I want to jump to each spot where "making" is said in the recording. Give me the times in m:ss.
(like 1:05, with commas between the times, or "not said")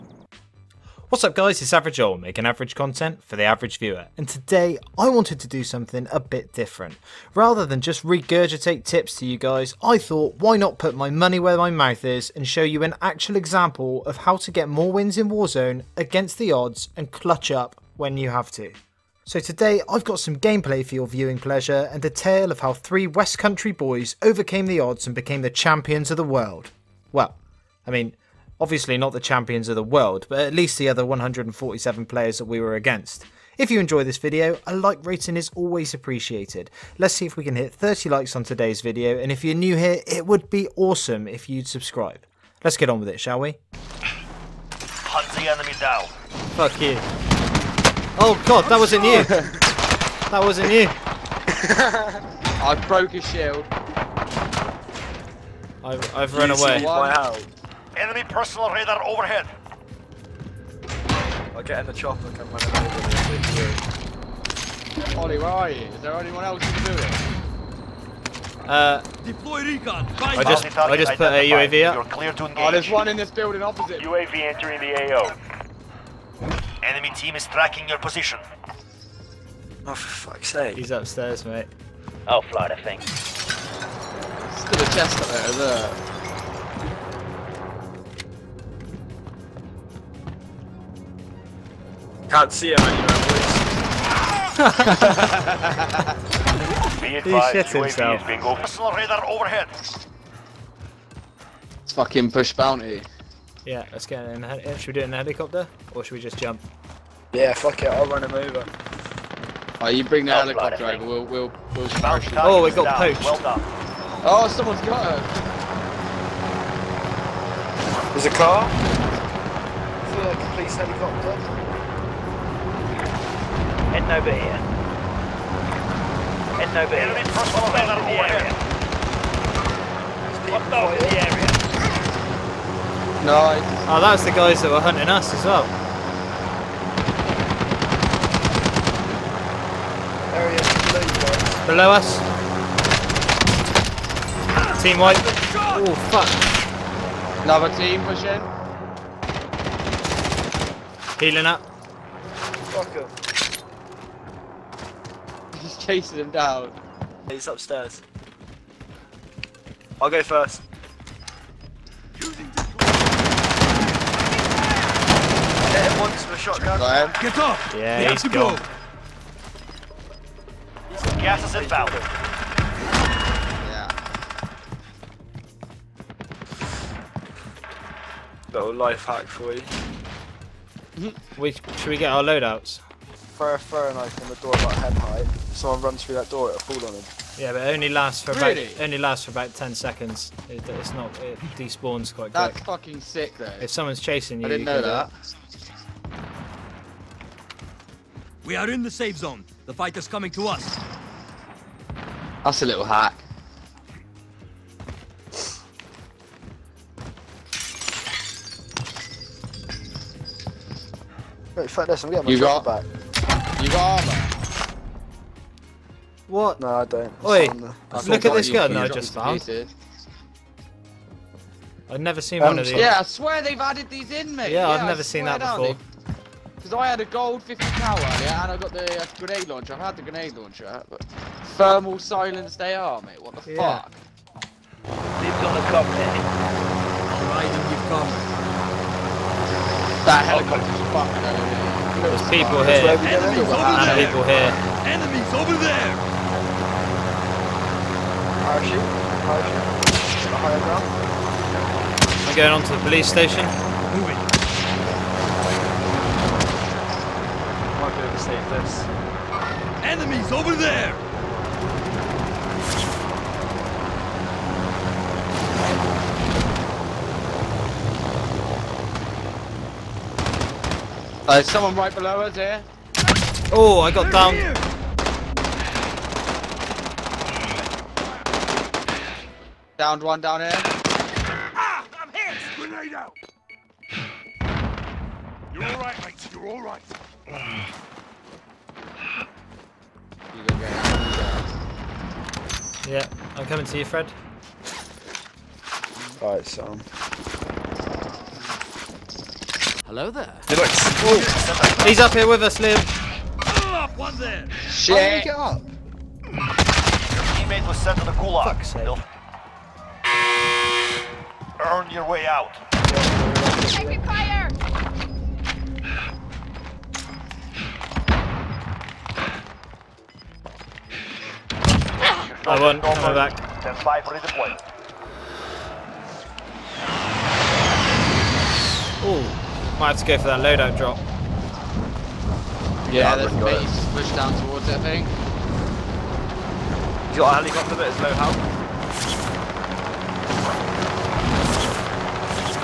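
0:02.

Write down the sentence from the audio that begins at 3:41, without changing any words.
I've never seen um, one of um, these.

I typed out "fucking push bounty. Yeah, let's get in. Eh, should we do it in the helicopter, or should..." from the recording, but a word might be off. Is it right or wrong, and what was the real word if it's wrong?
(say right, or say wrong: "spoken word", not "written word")
right.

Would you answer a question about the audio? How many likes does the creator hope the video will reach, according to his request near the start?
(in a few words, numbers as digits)
30.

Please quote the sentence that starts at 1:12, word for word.
Oh, there's one in this building opposite.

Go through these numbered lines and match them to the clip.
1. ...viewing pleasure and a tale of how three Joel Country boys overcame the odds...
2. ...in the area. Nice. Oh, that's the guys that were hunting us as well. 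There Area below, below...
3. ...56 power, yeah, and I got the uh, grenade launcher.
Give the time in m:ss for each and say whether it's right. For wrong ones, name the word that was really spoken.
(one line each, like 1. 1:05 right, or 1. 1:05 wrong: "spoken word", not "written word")
1. 0:21 wrong: "West", not "Joel"
2. 2:10 right
3. 3:47 wrong: "50", not "56".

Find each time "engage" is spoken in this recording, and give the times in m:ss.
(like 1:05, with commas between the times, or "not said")
1:12.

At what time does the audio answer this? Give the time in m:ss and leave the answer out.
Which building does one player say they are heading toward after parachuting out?
4:12.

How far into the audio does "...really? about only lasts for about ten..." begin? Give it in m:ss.
3:08.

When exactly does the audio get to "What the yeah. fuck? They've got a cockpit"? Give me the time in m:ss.
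3:53.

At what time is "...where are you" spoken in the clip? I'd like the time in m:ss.
1:05.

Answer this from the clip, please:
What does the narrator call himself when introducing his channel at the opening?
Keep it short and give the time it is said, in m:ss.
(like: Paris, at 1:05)
Average Joel, at 0:01.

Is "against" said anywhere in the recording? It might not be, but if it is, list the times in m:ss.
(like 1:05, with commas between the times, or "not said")
0:15, 0:32.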